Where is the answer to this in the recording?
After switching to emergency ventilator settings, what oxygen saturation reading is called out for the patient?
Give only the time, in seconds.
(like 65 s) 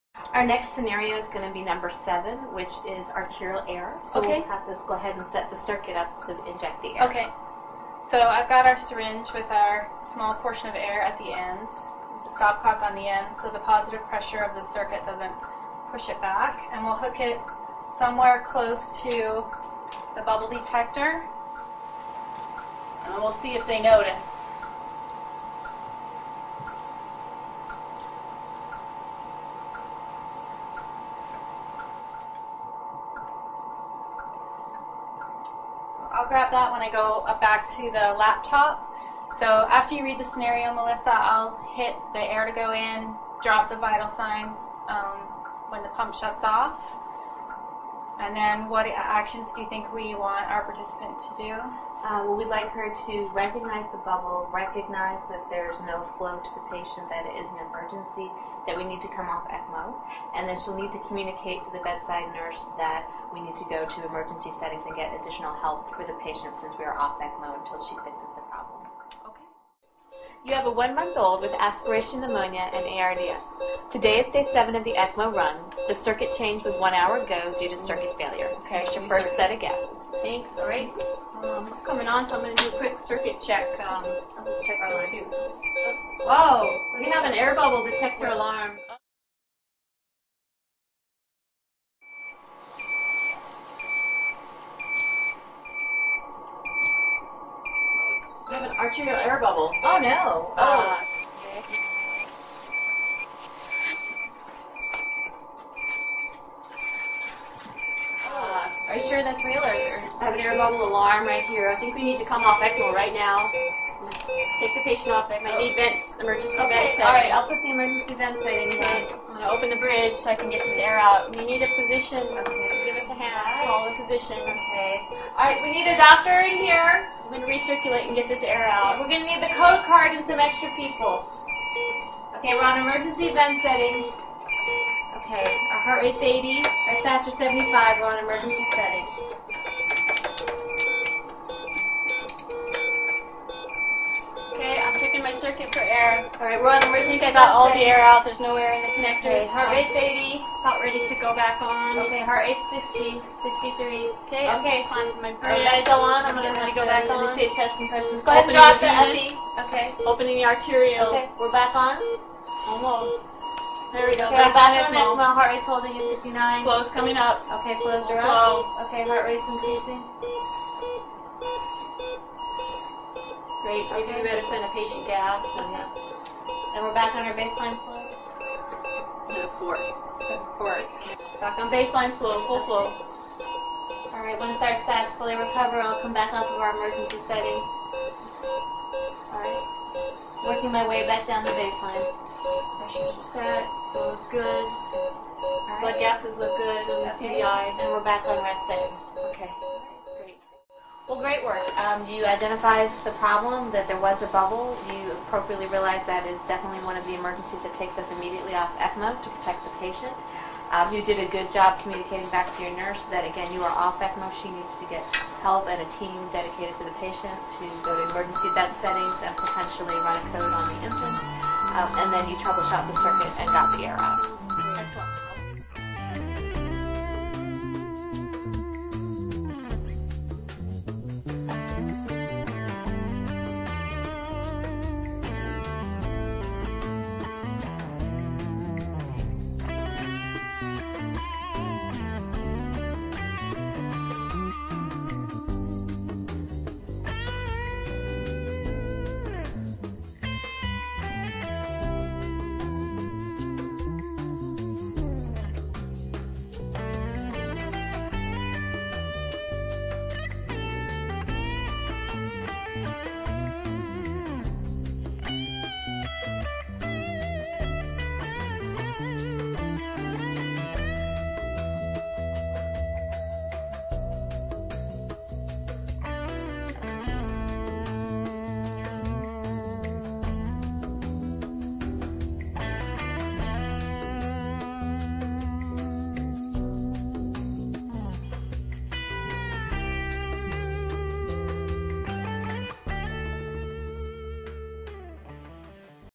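137 s.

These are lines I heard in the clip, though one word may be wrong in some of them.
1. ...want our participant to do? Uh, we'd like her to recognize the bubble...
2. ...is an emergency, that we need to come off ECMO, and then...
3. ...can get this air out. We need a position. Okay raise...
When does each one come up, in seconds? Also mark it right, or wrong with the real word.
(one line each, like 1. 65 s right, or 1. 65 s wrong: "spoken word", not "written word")
1. 50 s right
2. 57 s right
3. 120 s right.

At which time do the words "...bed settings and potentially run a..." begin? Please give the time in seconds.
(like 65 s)
218 s.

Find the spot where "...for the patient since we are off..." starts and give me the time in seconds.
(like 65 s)
65 s.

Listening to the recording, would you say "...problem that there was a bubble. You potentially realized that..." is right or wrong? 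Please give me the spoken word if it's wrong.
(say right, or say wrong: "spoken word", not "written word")
wrong: "appropriately", not "potentially".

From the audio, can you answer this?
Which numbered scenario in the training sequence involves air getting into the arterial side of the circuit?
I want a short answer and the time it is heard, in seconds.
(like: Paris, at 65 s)
7, at 1 s.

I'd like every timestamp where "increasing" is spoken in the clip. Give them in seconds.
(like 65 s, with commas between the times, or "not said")
169 s.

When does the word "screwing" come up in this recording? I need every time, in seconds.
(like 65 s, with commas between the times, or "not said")
not said.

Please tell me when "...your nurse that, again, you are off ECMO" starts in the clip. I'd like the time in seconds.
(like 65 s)
212 s.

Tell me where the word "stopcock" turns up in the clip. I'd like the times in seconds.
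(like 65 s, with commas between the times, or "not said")
12 s.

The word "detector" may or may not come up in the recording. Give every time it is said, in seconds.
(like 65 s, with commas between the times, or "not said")
20 s, 87 s.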